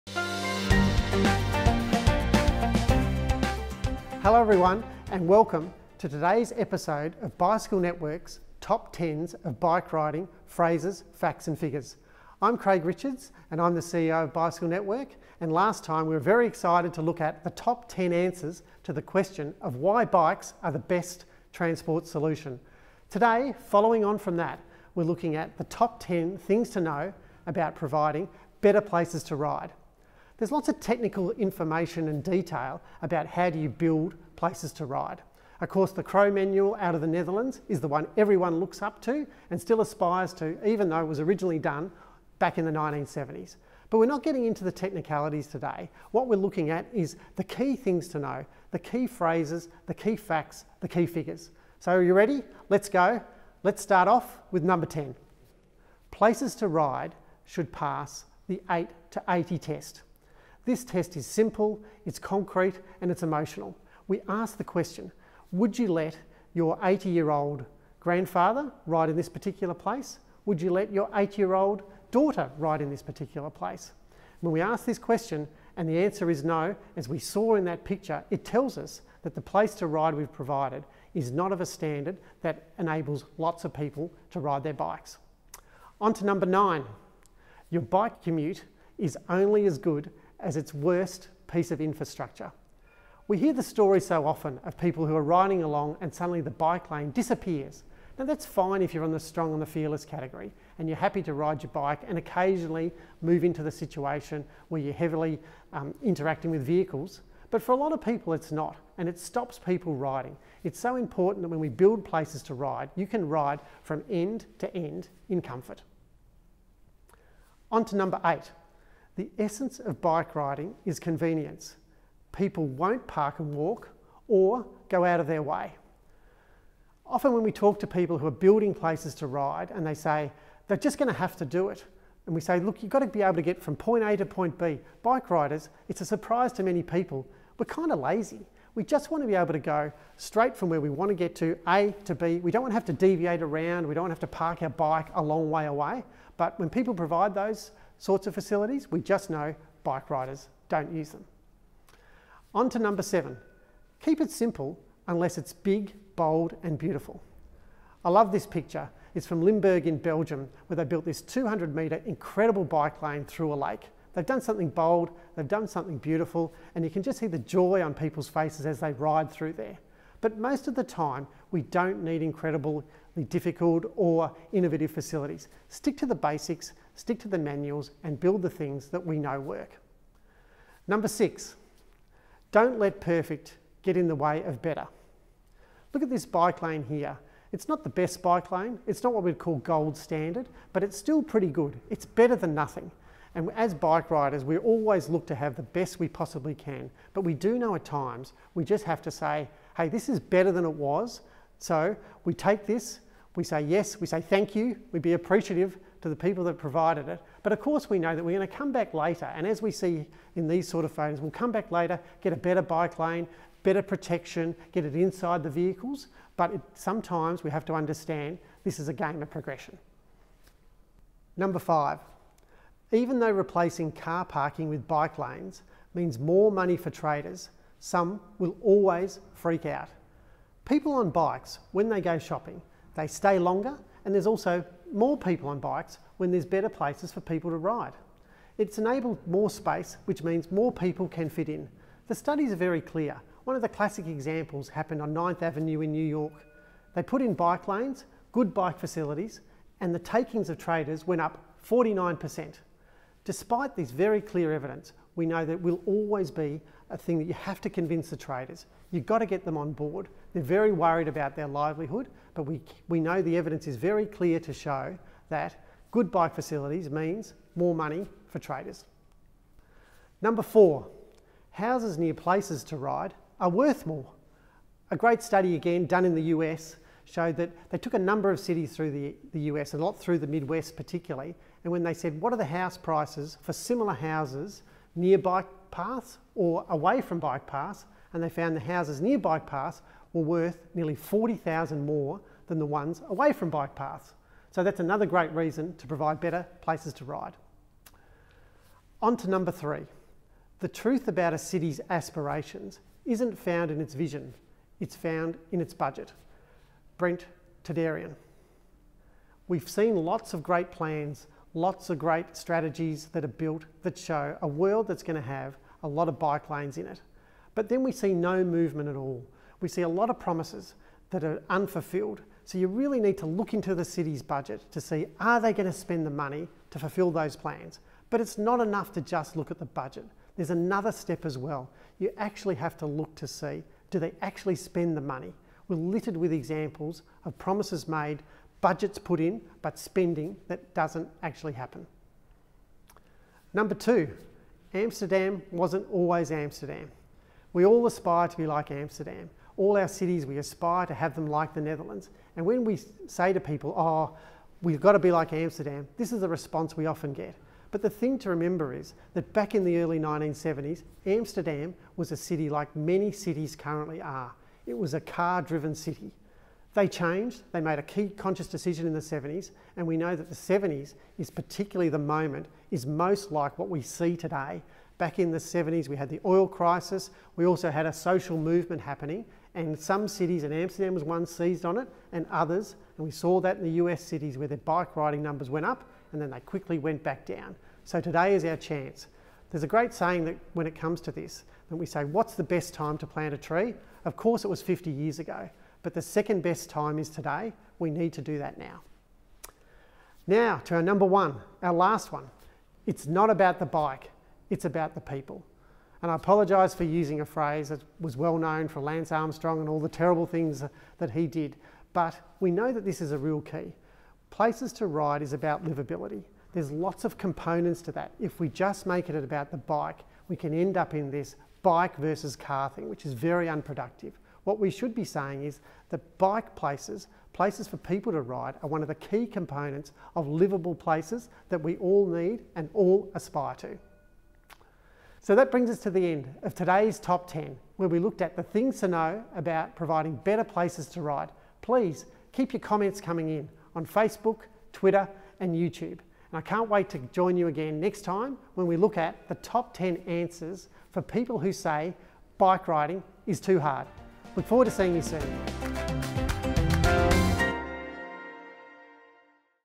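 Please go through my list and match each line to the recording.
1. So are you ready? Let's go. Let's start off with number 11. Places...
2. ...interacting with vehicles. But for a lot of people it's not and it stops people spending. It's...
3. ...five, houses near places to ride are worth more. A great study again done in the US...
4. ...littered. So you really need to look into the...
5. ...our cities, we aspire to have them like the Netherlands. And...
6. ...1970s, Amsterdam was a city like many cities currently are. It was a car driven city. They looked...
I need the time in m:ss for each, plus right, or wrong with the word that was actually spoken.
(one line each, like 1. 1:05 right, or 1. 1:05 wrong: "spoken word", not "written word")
1. 0:51 wrong: "10", not "11"
2. 1:46 wrong: "riding", not "spending"
3. 4:30 wrong: "four", not "five"
4. 5:21 wrong: "unfulfilled", not "littered"
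5. 5:49 right
6. 5:59 wrong: "changed", not "looked".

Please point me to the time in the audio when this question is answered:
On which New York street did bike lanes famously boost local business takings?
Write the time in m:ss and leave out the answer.
4:05.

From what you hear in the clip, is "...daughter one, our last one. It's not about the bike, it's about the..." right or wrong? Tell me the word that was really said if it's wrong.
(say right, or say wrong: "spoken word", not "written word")
wrong: "number", not "daughter".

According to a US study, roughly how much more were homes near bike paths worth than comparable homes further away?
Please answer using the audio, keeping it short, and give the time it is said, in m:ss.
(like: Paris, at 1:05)
40,000, at 4:50.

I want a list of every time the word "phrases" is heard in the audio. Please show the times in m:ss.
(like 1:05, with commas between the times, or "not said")
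0:10, 0:49, 6:47.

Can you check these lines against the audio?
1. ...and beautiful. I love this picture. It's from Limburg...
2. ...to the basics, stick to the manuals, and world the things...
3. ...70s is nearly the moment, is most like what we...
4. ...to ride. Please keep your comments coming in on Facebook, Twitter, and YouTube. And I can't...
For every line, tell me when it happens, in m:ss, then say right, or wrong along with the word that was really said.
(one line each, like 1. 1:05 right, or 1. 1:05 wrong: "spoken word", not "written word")
1. 2:36 right
2. 2:55 wrong: "build", not "world"
3. 6:10 wrong: "particularly", not "nearly"
4. 7:20 right.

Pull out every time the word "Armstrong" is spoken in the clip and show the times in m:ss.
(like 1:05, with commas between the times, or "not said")
6:49.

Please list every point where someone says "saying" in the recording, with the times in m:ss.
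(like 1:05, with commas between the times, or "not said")
6:29, 7:05.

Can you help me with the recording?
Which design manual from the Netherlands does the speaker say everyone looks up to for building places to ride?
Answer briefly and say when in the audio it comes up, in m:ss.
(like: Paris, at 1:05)
Crow Manual, at 0:36.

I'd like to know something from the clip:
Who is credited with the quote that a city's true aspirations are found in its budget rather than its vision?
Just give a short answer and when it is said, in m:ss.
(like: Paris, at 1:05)
Brent Toderian, at 5:06.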